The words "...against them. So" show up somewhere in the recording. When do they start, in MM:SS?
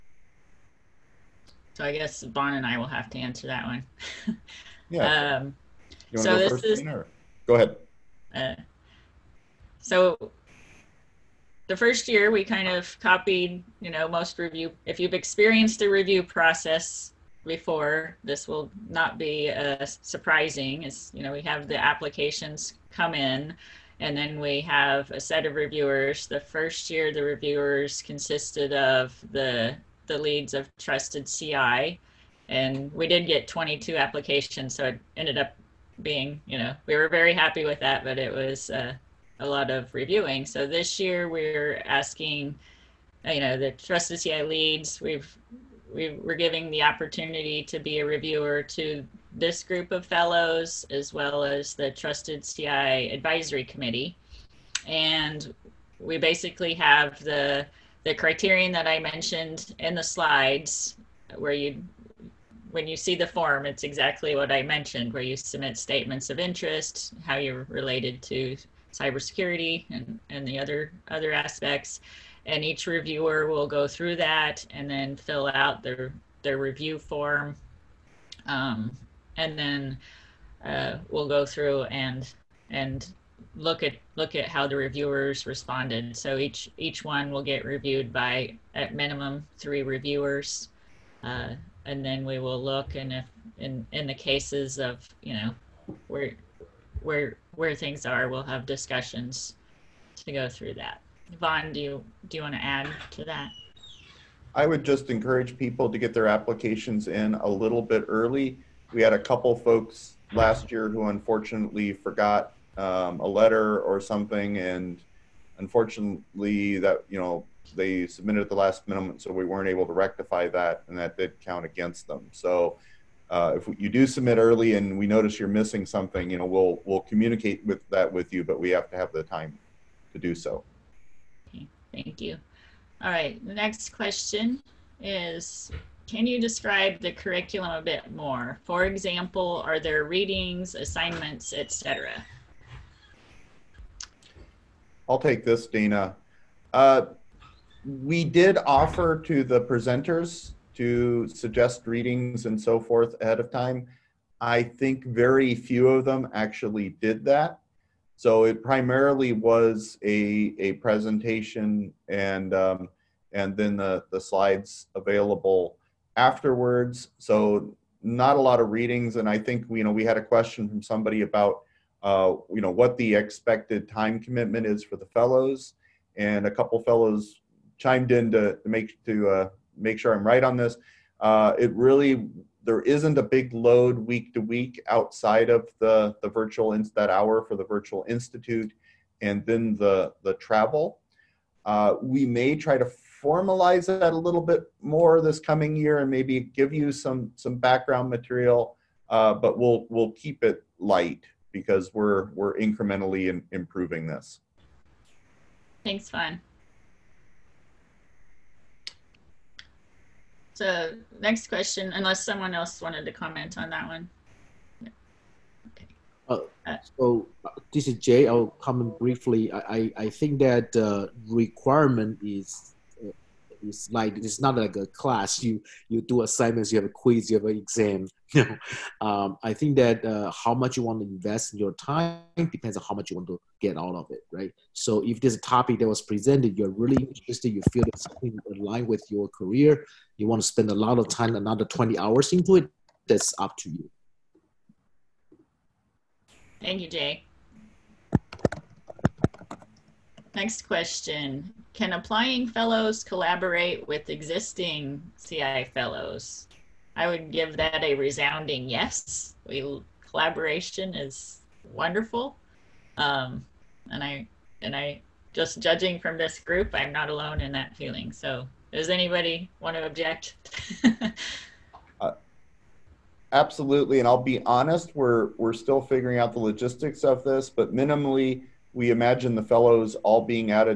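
02:01.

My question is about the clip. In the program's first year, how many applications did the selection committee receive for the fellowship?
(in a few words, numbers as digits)
22.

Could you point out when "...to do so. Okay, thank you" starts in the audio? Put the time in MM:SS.
02:10.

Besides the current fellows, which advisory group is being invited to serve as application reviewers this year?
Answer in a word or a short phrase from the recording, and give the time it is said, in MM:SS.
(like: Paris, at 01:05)
Trusted CI advisory committee, at 00:51.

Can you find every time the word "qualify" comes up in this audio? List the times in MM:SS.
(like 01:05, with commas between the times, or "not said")
not said.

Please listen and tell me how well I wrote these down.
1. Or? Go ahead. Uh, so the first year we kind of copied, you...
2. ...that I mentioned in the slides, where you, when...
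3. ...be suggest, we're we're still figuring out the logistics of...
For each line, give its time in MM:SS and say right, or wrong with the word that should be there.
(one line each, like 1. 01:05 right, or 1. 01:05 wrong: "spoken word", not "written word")
1. 00:06 right
2. 00:58 right
3. 04:34 wrong: "honest", not "suggest".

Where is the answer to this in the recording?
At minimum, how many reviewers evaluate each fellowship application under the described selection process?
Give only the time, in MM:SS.
01:29.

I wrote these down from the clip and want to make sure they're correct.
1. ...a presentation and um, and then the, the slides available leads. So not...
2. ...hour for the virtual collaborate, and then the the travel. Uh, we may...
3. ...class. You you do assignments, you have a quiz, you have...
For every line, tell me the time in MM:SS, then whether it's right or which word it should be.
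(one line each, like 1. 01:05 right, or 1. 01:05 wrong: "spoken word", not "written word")
1. 02:40 wrong: "afterwards", not "leads"
2. 03:07 wrong: "institute", not "collaborate"
3. 03:44 right.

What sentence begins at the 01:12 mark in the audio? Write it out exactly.
And each reviewer will go through that and then fill out their, their review form.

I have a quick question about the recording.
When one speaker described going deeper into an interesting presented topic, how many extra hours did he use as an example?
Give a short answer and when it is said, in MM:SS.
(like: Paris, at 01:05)
20 hours, at 04:01.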